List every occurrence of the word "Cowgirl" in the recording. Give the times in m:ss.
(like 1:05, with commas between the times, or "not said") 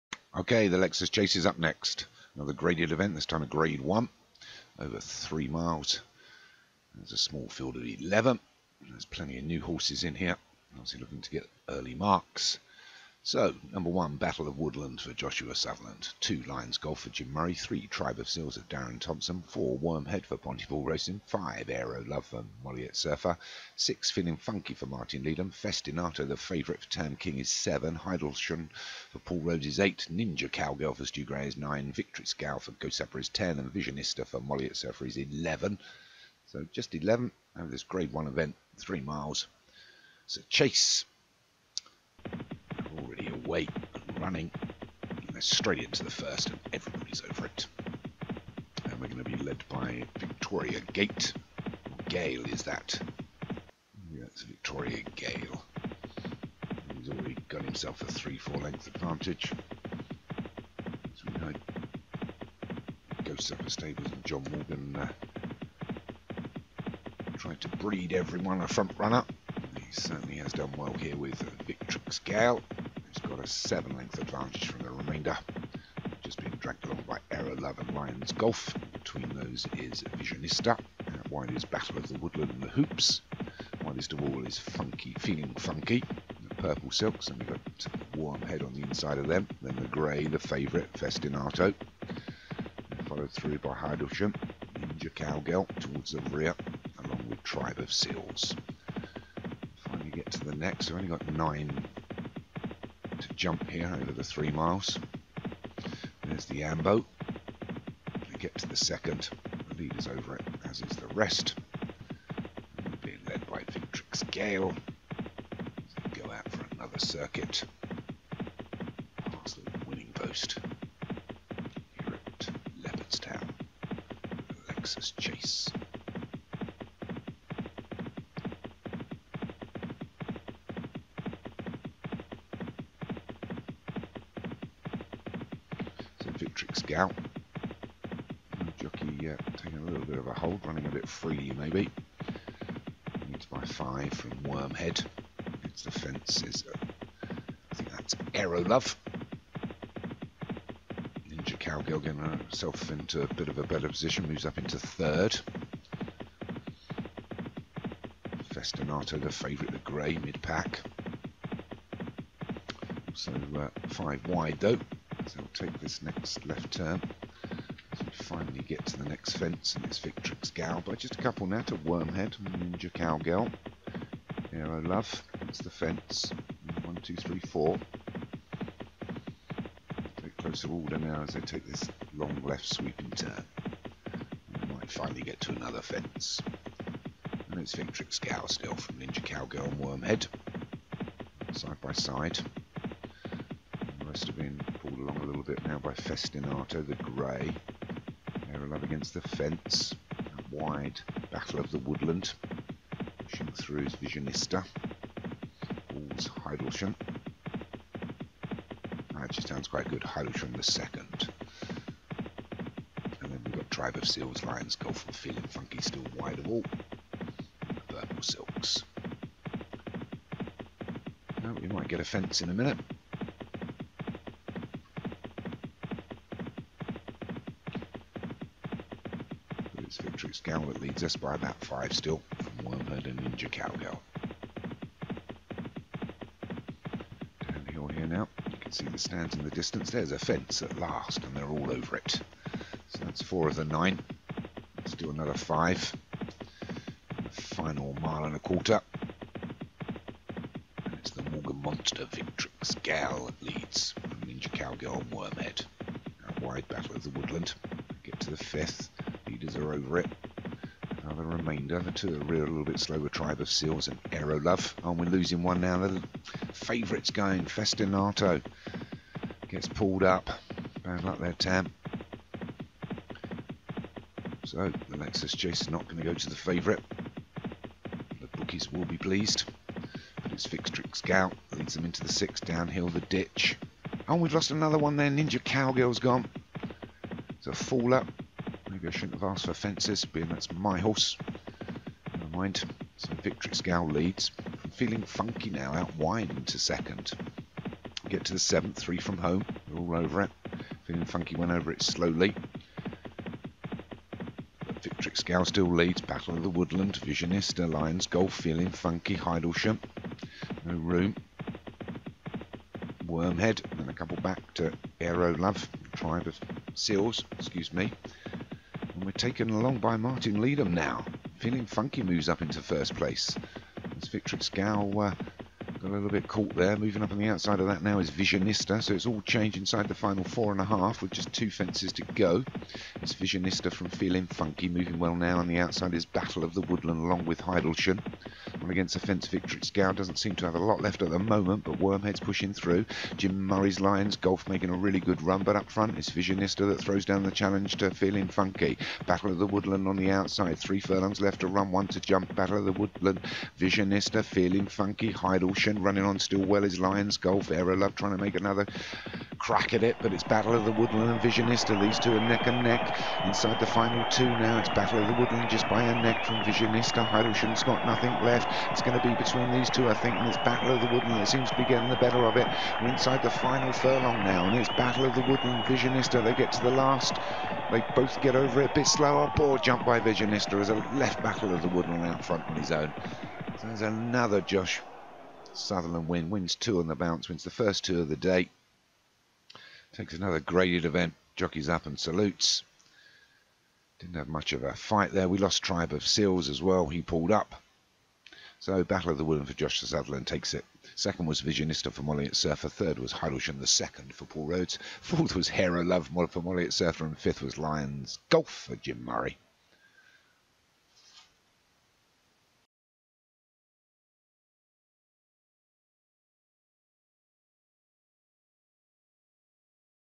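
0:30, 1:35, 2:31, 2:52, 3:09, 3:53, 4:14, 4:45.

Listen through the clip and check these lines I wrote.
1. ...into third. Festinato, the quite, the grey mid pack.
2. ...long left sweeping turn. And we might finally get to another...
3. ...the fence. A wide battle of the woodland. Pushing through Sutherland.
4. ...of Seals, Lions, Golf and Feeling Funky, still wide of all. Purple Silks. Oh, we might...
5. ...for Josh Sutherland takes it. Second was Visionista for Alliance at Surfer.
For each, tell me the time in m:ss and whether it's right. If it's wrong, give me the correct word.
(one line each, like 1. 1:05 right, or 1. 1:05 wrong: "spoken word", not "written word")
1. 2:34 wrong: "favourite", not "quite"
2. 3:02 right
3. 3:19 wrong: "Visionista", not "Sutherland"
4. 3:33 right
5. 6:39 wrong: "Molly", not "Alliance".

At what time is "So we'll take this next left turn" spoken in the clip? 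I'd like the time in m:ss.
2:45.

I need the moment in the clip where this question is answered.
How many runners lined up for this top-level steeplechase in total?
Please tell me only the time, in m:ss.
0:07.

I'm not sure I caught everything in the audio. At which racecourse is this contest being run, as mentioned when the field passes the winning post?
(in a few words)
Leopardstown.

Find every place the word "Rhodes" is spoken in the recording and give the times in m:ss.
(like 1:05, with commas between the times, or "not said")
0:29, 6:44.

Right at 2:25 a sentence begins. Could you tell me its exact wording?
It's the fence is, uh, I think that's Aero Love.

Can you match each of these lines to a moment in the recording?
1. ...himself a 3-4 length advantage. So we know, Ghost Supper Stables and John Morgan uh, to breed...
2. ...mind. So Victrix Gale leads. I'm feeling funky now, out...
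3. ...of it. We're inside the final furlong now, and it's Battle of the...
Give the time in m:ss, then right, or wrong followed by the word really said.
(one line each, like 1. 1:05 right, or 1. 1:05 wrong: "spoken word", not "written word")
1. 0:57 right
2. 4:52 right
3. 6:12 right.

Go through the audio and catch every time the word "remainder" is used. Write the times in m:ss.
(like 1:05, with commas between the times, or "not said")
1:14, 4:21.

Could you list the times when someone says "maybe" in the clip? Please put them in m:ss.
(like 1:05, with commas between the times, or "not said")
2:21, 4:48.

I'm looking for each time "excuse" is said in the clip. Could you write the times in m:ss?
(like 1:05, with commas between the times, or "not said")
5:17.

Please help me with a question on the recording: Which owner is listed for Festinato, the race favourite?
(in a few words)
Tam King.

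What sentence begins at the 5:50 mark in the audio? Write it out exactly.
Three furlongs left to run, one to jump.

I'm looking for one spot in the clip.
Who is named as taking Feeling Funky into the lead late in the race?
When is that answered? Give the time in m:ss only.
5:19.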